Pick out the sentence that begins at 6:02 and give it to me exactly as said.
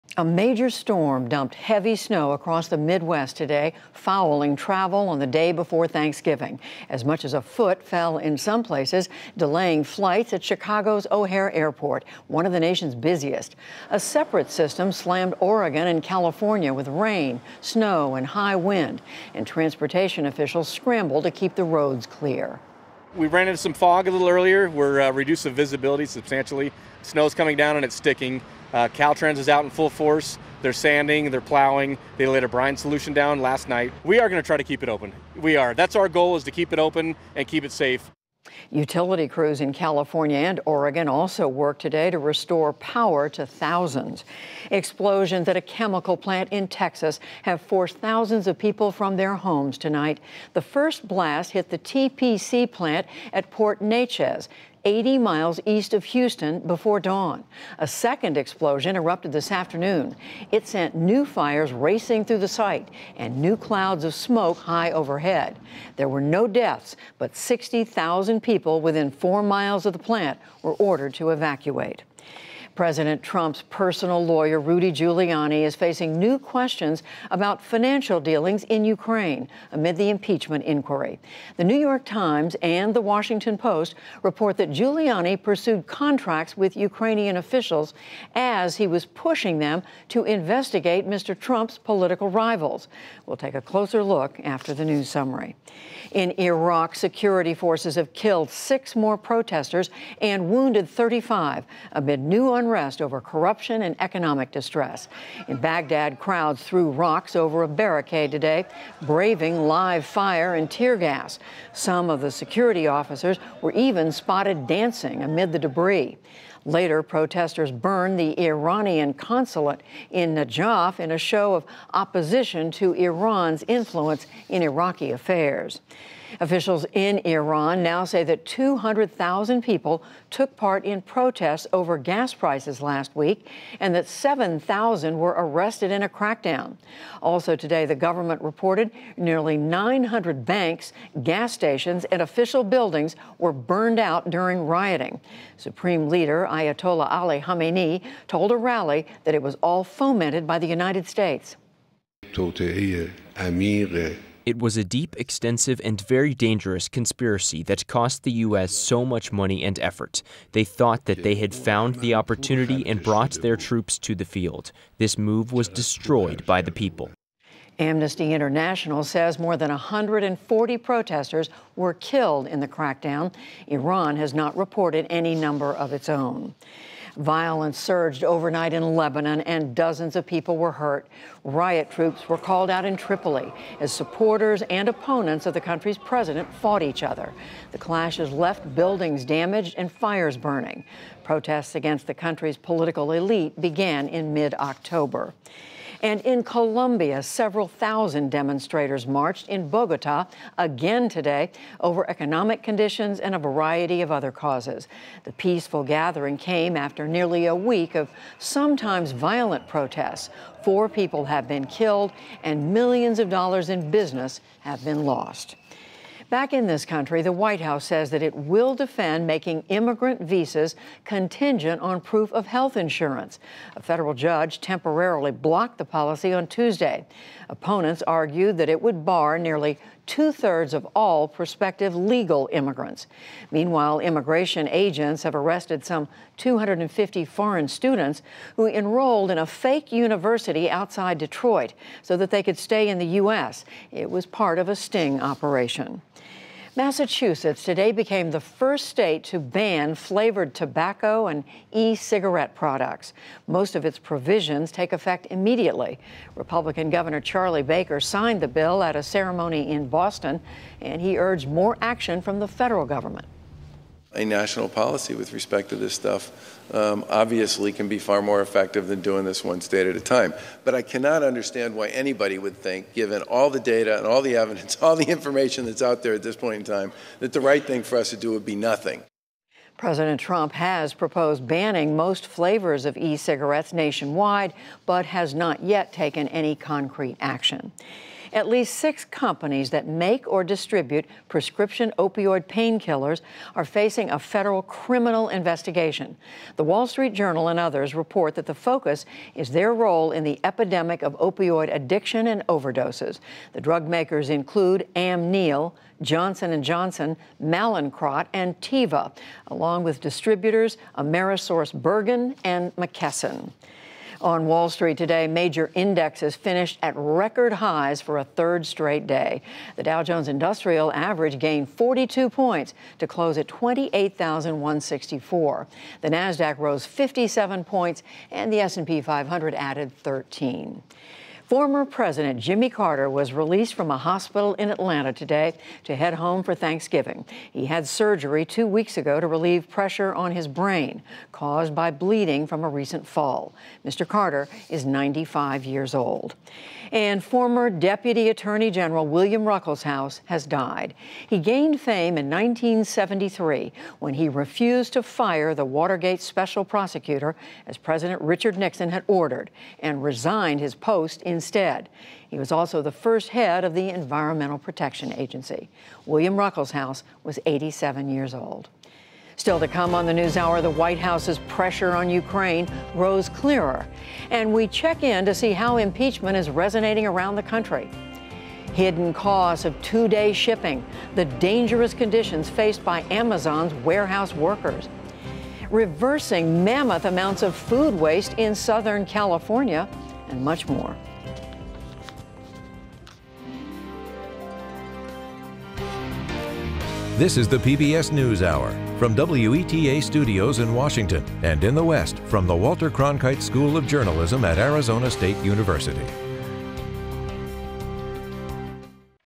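He was also the first head of the Environmental Protection Agency.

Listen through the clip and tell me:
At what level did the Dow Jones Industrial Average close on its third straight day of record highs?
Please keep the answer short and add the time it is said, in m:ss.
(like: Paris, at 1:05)
28,164, at 5:23.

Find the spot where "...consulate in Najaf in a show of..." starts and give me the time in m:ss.
1:59.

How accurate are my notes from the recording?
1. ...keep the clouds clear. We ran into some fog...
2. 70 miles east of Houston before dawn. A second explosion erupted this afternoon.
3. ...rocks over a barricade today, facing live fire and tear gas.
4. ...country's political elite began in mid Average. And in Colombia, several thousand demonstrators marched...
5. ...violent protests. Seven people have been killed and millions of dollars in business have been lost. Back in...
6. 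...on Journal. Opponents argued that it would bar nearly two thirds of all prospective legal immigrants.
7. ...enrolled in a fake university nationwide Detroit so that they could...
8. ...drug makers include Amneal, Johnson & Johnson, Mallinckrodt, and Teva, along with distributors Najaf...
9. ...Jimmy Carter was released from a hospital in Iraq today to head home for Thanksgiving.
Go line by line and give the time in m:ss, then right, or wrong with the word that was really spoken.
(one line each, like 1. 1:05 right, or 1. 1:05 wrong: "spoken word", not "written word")
1. 0:21 wrong: "roads", not "clouds"
2. 0:54 wrong: "80", not "70"
3. 1:46 wrong: "braving", not "facing"
4. 3:12 wrong: "October", not "Average"
5. 3:29 wrong: "Four", not "Seven"
6. 3:46 wrong: "Tuesday", not "Journal"
7. 3:58 wrong: "outside", not "nationwide"
8. 5:03 wrong: "Amerisource", not "Najaf"
9. 5:32 wrong: "Atlanta", not "Iraq".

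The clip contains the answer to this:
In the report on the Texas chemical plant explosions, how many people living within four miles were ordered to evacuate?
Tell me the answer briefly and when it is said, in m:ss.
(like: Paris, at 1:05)
60,000, at 1:07.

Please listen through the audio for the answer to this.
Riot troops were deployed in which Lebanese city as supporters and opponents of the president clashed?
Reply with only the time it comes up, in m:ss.
3:02.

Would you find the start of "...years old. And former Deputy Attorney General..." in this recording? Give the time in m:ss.
5:45.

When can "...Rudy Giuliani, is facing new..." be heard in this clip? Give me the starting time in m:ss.
1:14.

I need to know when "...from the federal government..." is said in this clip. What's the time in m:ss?
4:22.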